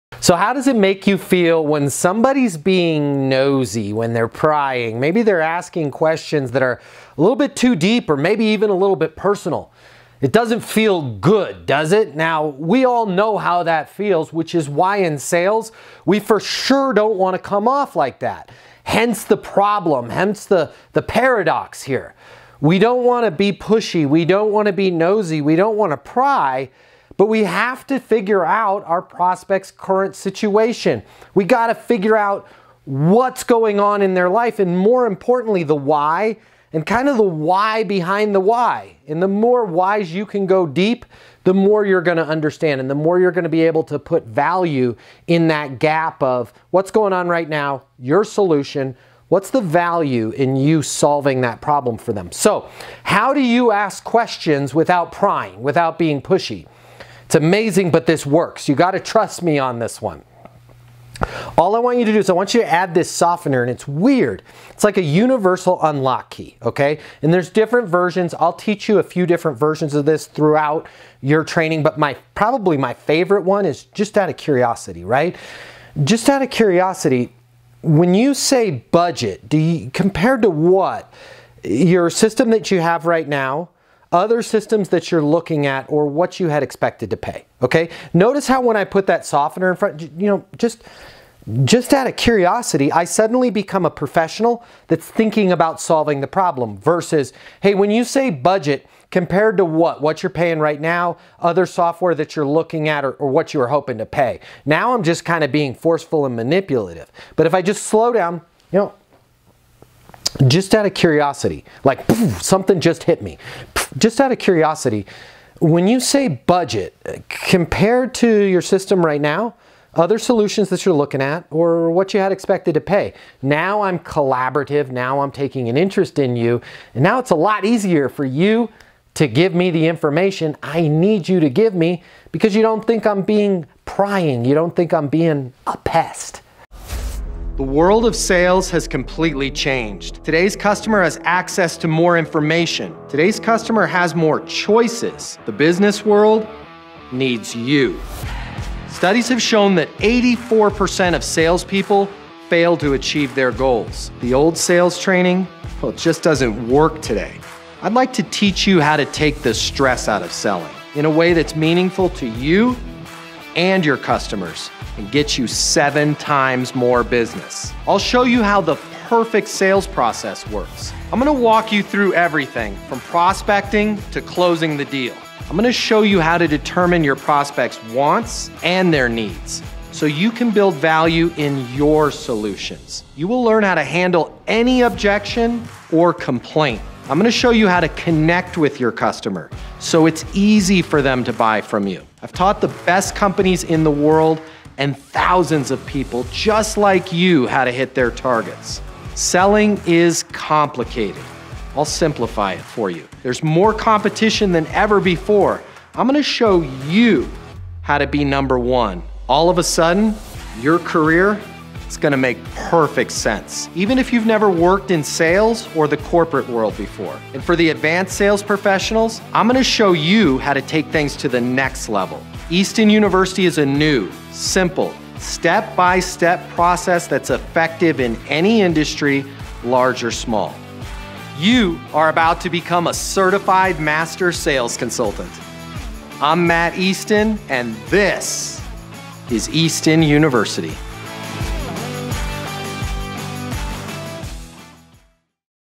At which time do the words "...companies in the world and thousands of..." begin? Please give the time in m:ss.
3:13.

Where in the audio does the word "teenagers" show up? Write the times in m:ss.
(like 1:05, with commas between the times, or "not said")
not said.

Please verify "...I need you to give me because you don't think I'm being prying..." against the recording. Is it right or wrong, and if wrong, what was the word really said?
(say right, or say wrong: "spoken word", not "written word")
right.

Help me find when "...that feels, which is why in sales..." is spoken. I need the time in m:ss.
0:13.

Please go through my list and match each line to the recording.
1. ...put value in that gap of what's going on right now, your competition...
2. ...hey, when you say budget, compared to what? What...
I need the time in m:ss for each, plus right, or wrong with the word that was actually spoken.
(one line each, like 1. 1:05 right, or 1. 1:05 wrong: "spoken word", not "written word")
1. 0:43 wrong: "solution", not "competition"
2. 1:37 right.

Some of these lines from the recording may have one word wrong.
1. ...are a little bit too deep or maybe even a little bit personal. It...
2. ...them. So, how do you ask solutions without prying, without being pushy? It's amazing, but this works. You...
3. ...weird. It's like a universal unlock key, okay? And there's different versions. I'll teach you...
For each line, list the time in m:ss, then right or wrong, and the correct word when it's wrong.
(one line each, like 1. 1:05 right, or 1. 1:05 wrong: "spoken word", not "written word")
1. 0:06 right
2. 0:52 wrong: "questions", not "solutions"
3. 1:03 right.